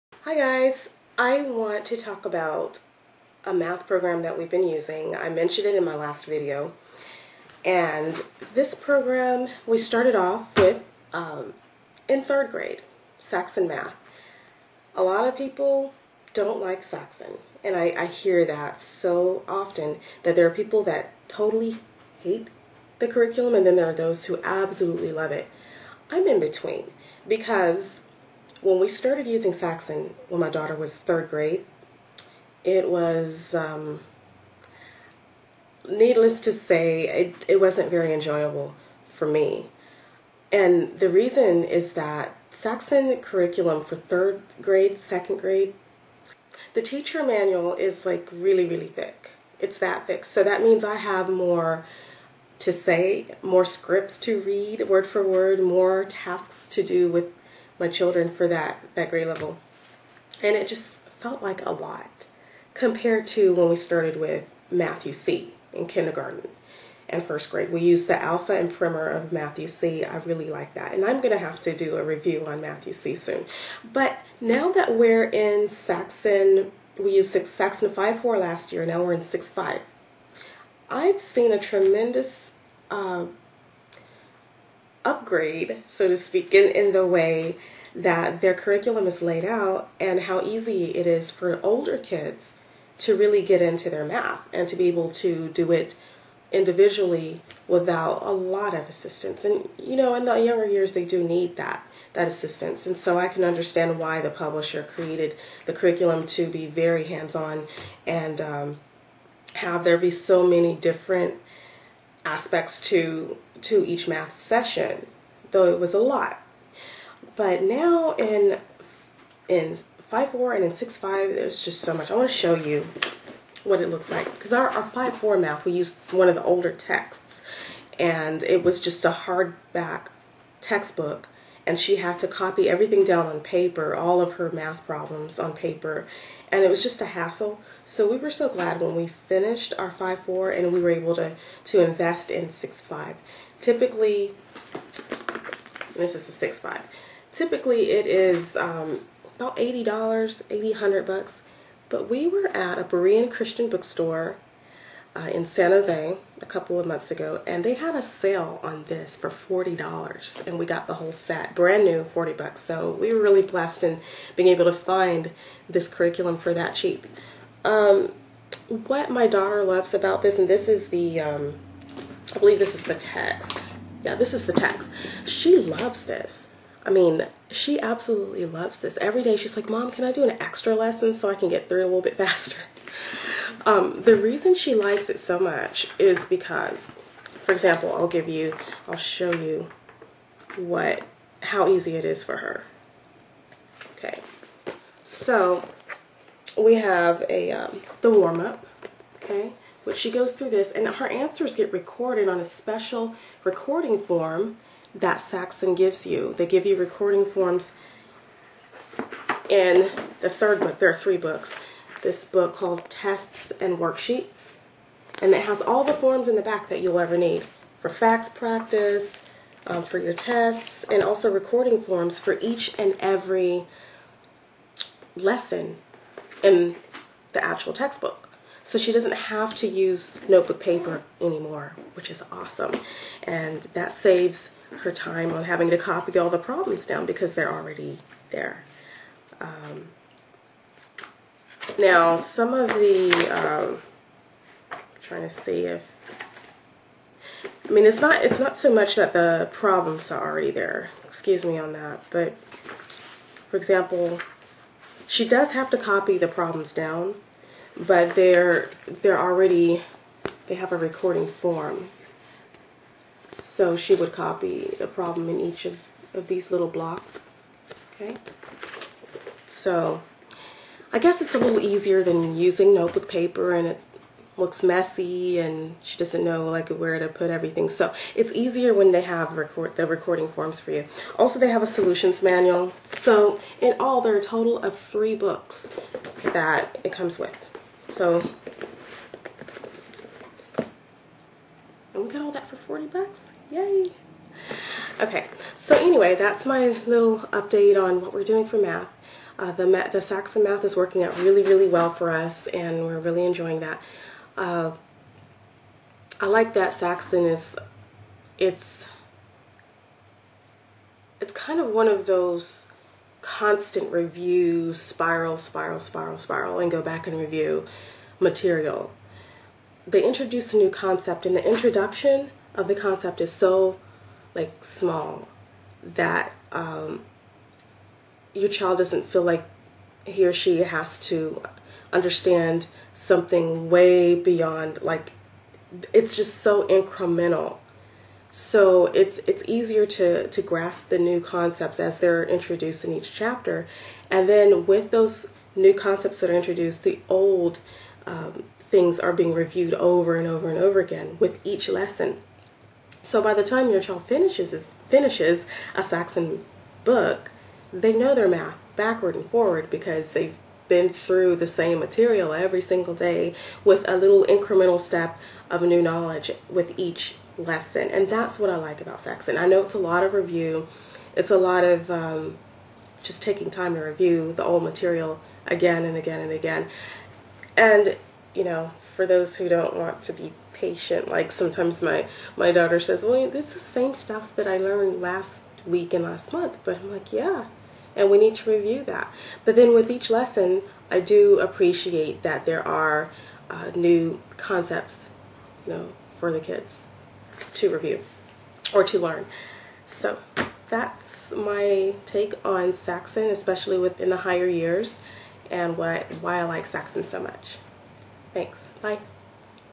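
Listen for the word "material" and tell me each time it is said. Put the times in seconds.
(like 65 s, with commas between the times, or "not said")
318 s, 361 s, 374 s.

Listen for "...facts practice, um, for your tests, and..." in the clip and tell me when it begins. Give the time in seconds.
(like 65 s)
217 s.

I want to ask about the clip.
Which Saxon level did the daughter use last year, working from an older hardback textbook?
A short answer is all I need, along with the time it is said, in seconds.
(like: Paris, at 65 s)
Saxon 5-4, at 77 s.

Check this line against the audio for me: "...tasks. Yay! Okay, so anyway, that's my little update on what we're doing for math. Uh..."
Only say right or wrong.
wrong.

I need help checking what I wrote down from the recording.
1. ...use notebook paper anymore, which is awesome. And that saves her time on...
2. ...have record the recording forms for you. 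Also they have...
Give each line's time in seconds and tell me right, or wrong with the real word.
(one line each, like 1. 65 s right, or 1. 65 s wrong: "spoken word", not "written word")
1. 229 s right
2. 279 s right.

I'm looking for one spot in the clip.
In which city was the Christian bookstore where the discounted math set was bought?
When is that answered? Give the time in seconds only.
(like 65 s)
155 s.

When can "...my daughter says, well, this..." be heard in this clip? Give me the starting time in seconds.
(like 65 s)
382 s.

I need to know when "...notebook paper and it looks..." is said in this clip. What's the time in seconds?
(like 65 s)
272 s.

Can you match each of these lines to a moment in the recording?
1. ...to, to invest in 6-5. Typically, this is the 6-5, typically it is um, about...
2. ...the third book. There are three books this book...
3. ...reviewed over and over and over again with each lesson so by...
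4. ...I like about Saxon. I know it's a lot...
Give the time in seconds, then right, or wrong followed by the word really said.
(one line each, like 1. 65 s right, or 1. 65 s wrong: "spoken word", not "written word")
1. 141 s right
2. 210 s right
3. 349 s right
4. 368 s right.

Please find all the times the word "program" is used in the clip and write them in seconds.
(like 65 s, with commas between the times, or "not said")
3 s, 8 s.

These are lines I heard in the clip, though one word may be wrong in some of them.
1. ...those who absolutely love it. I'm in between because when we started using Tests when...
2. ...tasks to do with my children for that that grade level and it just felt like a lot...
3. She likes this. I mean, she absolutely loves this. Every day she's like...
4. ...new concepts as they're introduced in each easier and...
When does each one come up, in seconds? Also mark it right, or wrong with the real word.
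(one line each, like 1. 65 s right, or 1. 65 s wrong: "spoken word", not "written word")
1. 23 s wrong: "Saxon", not "Tests"
2. 56 s right
3. 175 s wrong: "loves", not "likes"
4. 340 s wrong: "chapter", not "easier".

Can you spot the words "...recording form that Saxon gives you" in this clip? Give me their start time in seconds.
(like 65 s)
203 s.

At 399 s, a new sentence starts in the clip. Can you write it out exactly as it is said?
So that's my take on Saxon, especially within the higher years, and what why I like Saxon so much.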